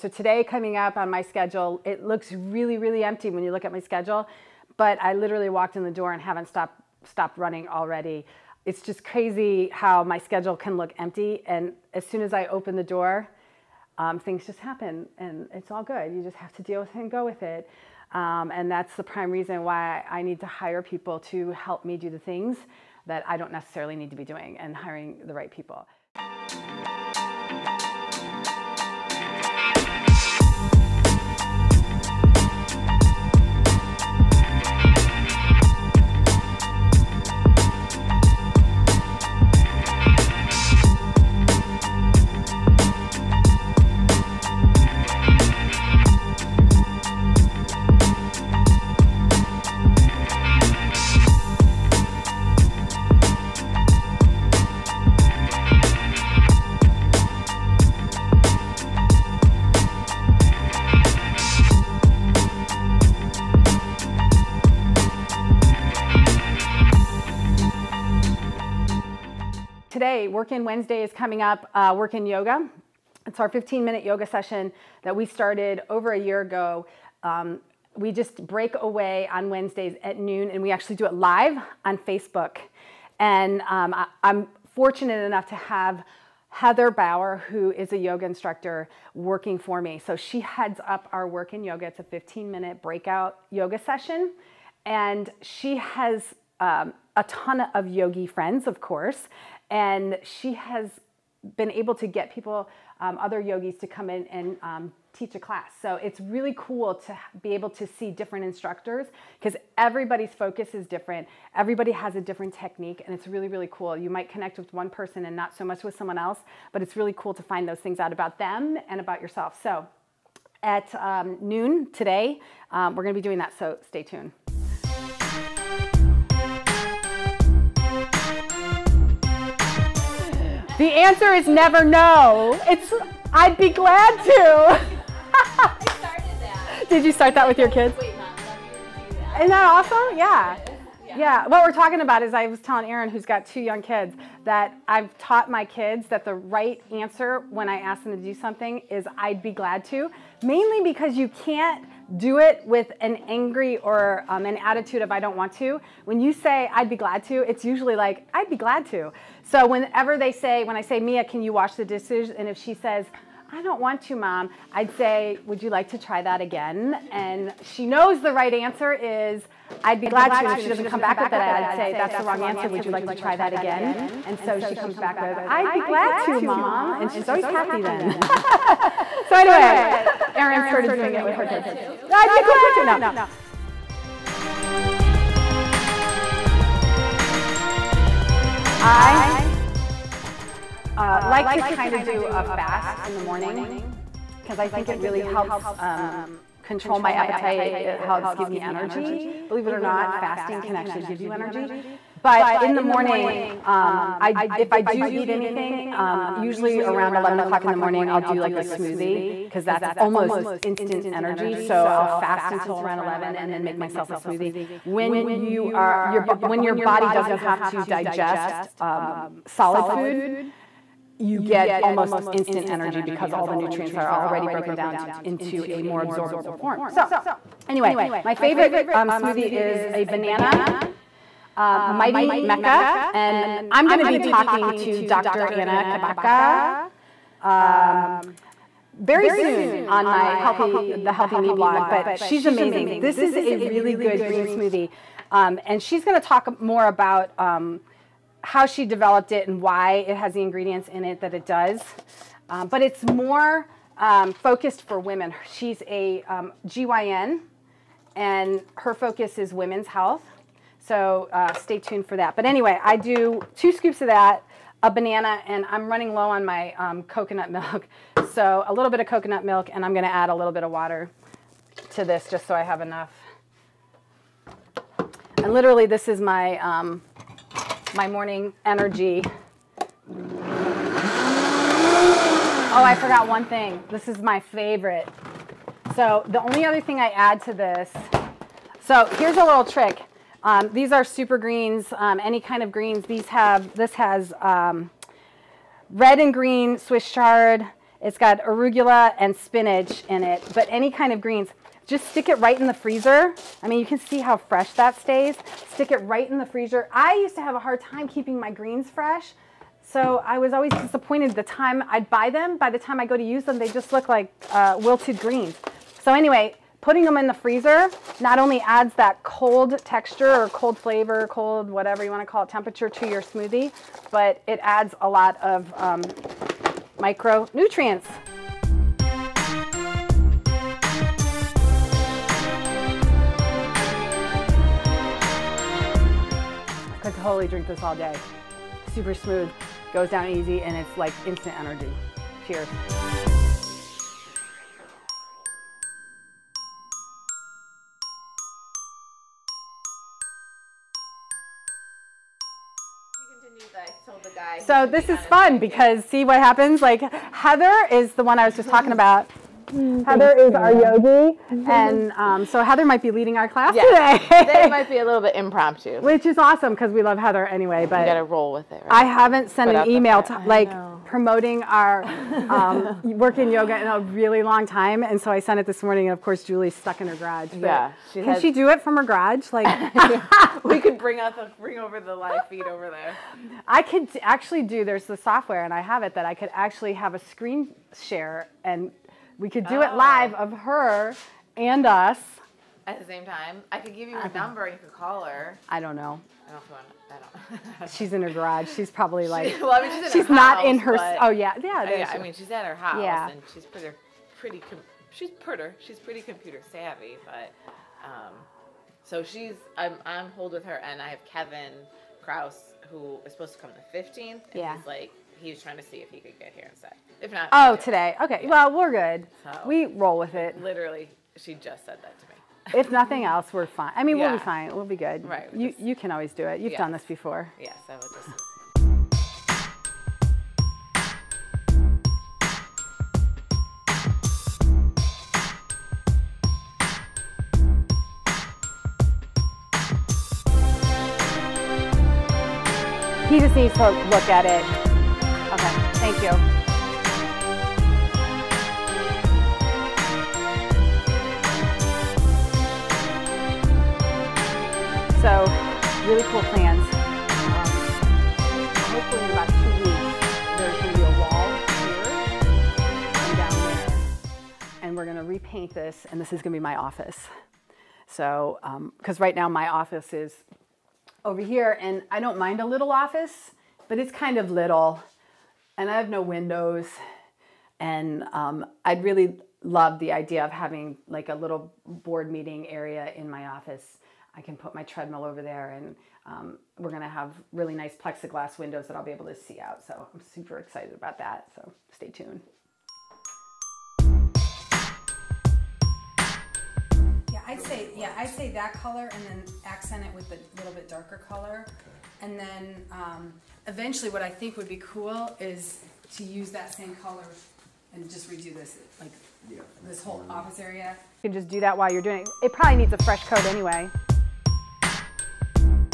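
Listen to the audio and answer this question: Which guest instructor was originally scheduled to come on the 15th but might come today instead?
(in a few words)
Kevin Kraus.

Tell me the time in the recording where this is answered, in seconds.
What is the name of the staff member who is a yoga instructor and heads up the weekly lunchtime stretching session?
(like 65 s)
86 s.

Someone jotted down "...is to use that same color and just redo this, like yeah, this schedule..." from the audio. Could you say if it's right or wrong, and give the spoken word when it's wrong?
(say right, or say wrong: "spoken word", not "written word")
wrong: "whole", not "schedule".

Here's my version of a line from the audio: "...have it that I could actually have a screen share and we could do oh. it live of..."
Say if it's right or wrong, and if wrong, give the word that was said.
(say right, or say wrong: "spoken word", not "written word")
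right.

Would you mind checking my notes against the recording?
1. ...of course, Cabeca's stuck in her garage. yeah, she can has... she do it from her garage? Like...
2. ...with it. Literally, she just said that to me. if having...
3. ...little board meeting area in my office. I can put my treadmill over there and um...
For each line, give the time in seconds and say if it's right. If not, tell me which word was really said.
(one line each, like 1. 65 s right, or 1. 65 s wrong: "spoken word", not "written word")
1. 376 s wrong: "Julie", not "Cabeca"
2. 420 s wrong: "nothing", not "having"
3. 481 s right.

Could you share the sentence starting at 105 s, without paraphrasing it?
So it's really cool to be able to see different instructors because everybody's focus is different.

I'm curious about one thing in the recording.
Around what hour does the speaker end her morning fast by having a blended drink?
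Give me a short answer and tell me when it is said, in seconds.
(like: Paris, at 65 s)
11 o'clock, at 207 s.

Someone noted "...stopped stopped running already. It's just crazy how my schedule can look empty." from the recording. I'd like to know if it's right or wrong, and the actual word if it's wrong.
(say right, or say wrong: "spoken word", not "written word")
right.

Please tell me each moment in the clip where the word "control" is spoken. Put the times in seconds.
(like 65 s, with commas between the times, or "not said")
196 s.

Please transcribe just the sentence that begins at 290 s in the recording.
Um, these are super greens, um, any kind of greens.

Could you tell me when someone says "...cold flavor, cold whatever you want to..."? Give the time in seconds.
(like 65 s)
320 s.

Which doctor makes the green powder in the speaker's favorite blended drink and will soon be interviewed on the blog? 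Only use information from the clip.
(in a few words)
Dr. Anna Cabeca.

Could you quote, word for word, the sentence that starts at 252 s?
Um, but it's more um, focused for women.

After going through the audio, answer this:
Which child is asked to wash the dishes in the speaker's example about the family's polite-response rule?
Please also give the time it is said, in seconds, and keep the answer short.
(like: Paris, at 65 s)
Mia, at 160 s.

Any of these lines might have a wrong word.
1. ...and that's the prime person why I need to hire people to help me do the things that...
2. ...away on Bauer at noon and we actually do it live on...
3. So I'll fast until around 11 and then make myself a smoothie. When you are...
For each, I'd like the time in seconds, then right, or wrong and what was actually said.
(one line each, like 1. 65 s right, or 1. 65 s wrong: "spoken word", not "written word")
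1. 18 s wrong: "reason", not "person"
2. 78 s wrong: "Wednesdays", not "Bauer"
3. 211 s right.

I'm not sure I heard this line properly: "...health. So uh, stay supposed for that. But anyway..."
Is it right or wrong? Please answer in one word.
wrong.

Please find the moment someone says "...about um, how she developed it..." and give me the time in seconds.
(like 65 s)
246 s.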